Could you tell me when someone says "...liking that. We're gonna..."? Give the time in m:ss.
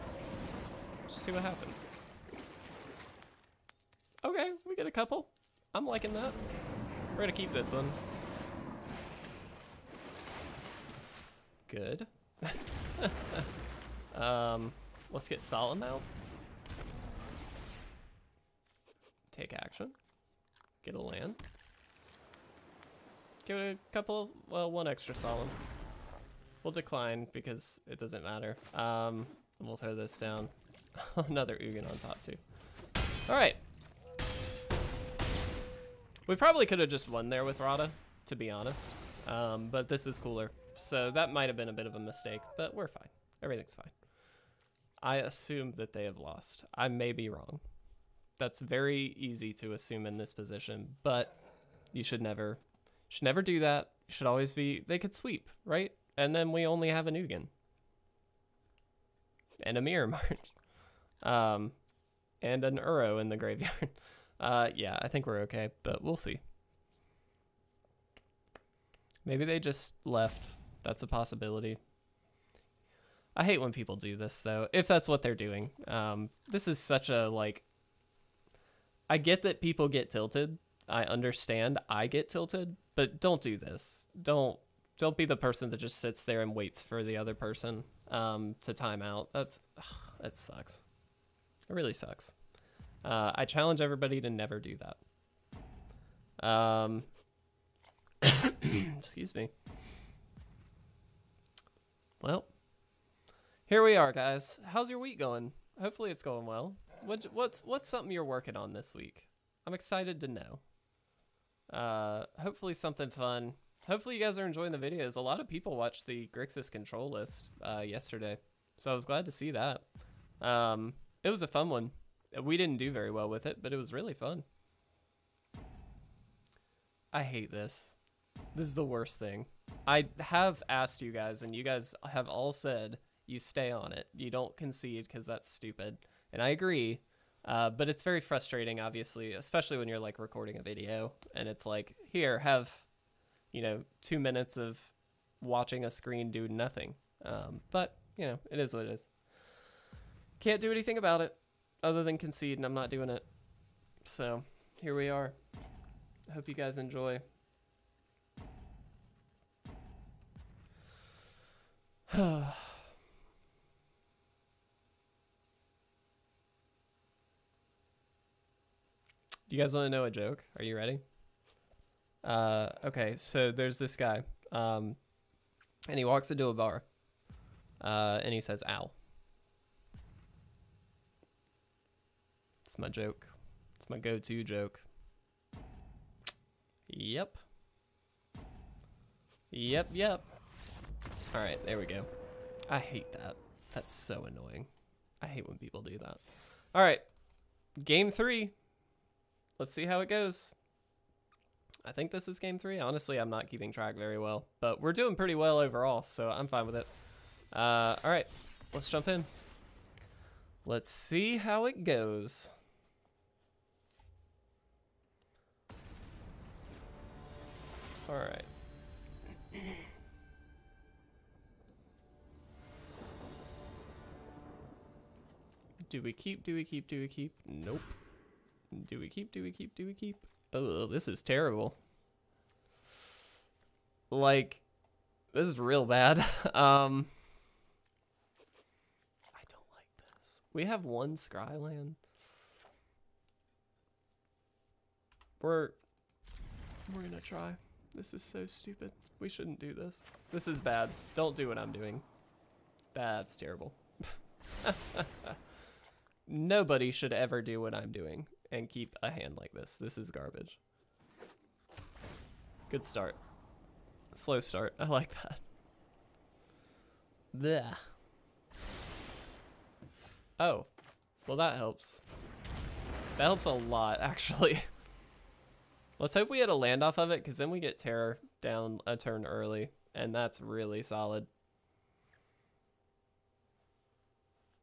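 0:05.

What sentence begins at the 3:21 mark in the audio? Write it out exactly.
I think this is game three.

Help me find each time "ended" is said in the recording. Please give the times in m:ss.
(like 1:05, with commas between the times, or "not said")
not said.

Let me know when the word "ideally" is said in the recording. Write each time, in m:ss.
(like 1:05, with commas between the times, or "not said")
not said.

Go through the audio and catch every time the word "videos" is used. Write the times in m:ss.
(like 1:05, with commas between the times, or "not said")
1:54, 2:20.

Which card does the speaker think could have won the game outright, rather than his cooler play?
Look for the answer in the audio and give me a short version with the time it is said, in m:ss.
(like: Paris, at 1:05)
Radha, at 0:37.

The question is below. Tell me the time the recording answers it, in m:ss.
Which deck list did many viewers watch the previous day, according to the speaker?
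1:56.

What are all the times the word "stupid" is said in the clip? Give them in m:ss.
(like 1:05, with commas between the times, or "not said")
2:15, 4:08.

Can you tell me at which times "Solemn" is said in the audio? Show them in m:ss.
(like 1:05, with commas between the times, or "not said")
0:15, 0:25.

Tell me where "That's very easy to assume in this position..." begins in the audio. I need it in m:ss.
0:48.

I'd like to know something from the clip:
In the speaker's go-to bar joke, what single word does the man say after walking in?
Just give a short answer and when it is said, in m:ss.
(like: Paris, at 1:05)
Ow, at 2:58.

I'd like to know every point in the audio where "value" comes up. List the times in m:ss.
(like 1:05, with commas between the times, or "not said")
not said.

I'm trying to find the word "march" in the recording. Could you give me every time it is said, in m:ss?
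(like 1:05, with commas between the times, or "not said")
1:00.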